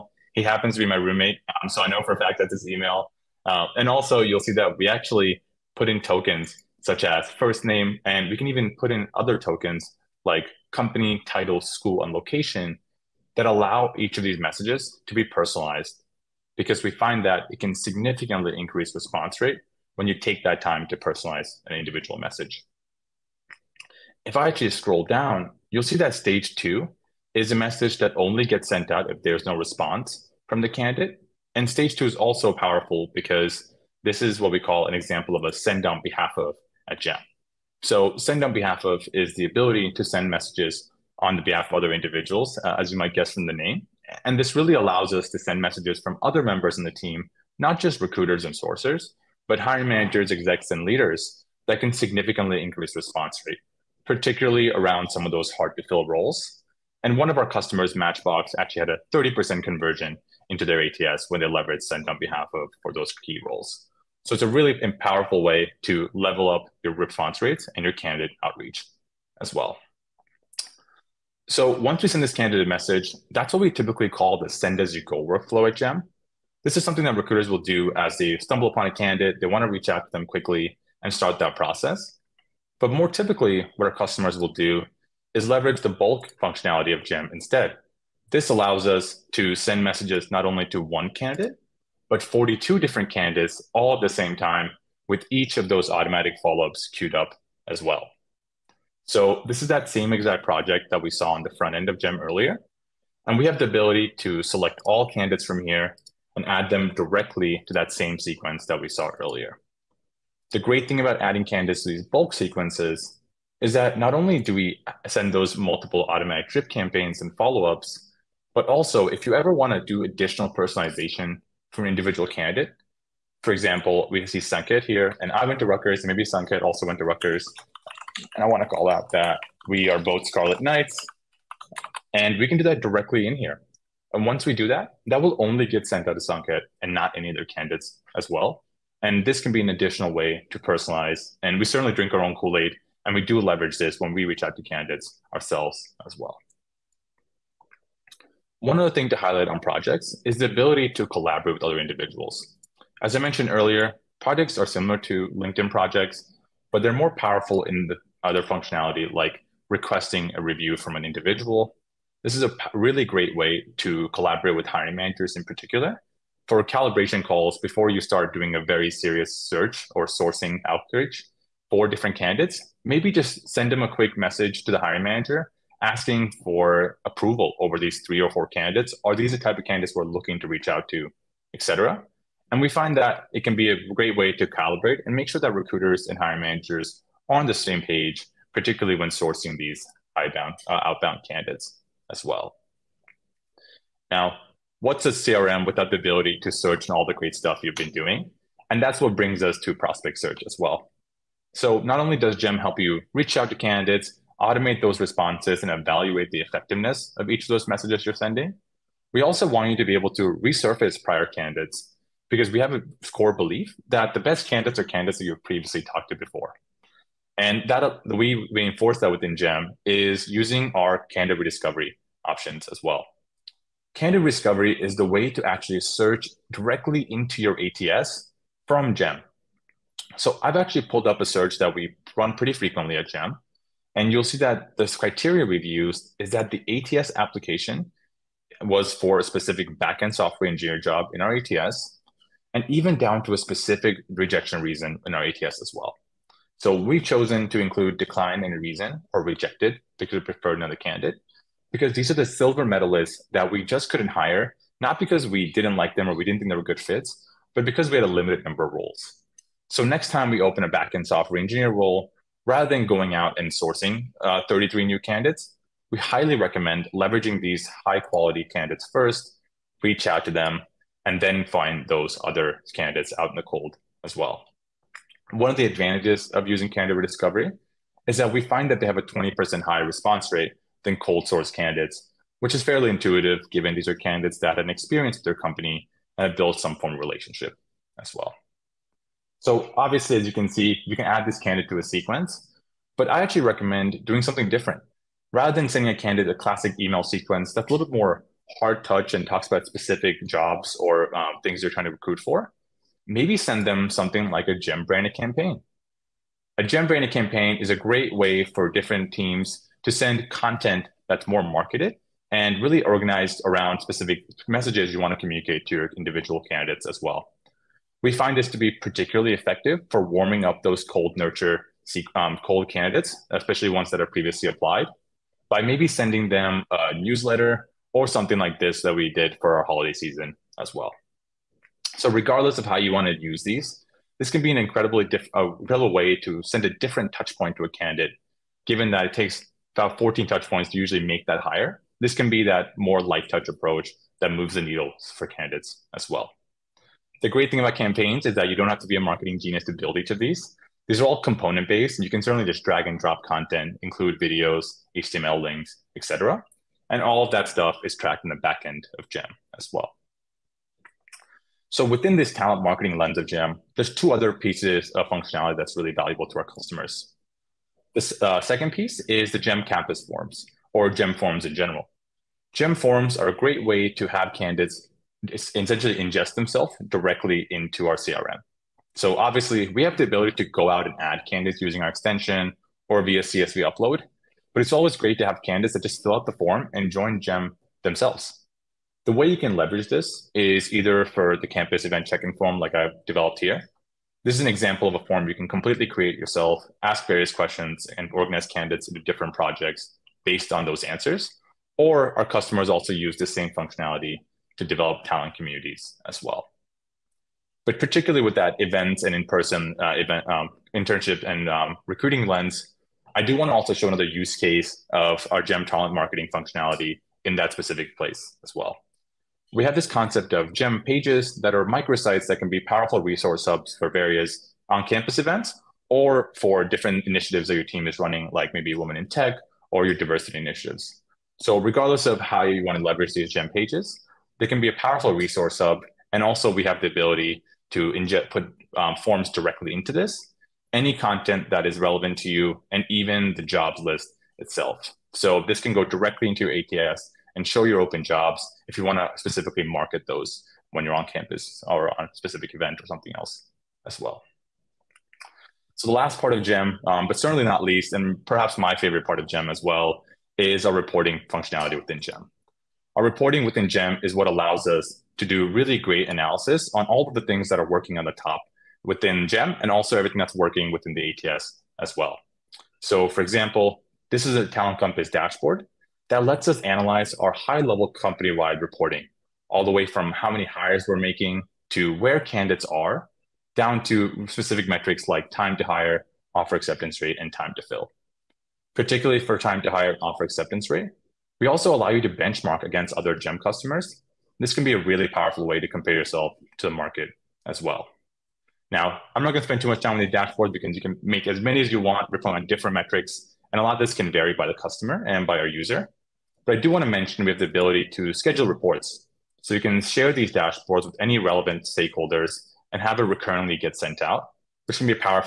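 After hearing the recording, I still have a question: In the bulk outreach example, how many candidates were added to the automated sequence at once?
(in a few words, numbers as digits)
42.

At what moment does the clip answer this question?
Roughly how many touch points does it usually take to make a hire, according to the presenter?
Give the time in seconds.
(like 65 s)
339 s.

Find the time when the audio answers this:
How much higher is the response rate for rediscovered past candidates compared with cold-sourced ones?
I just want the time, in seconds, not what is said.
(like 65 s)
279 s.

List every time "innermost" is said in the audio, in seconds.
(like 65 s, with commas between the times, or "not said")
not said.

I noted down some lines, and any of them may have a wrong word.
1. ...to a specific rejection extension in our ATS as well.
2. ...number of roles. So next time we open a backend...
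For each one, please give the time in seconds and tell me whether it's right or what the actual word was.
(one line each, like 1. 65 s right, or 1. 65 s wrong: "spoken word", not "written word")
1. 243 s wrong: "reason", not "extension"
2. 258 s right.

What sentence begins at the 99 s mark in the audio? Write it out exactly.
So this is that same exact project that we saw on the front end of GEM earlier.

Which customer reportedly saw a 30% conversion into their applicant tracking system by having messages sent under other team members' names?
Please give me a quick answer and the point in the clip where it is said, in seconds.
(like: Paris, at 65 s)
Matchbox, at 57 s.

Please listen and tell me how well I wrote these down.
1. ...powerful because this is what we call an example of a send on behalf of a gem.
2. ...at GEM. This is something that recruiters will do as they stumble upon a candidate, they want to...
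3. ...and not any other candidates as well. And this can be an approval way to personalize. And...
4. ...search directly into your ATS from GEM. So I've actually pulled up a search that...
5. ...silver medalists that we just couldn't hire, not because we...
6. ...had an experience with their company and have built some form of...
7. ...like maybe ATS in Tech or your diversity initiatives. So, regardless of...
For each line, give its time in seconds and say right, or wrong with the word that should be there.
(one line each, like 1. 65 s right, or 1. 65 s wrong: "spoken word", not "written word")
1. 32 s right
2. 75 s right
3. 136 s wrong: "additional", not "approval"
4. 225 s right
5. 252 s right
6. 284 s right
7. 428 s wrong: "Women", not "ATS".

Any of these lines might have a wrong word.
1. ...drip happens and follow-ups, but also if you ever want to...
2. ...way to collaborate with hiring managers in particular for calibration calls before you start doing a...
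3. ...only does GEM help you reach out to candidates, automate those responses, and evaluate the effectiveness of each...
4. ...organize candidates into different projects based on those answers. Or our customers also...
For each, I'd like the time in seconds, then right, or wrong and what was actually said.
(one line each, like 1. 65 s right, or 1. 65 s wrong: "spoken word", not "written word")
1. 116 s wrong: "campaigns", not "happens"
2. 163 s right
3. 202 s right
4. 398 s right.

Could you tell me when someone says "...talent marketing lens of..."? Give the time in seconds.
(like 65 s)
362 s.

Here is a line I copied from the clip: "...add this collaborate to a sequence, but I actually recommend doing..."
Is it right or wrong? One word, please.
wrong.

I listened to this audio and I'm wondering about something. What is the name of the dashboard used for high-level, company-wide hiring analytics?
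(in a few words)
Talent Compass.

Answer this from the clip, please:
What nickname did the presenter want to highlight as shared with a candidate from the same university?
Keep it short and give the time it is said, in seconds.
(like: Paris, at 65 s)
Scarlet Knights, at 130 s.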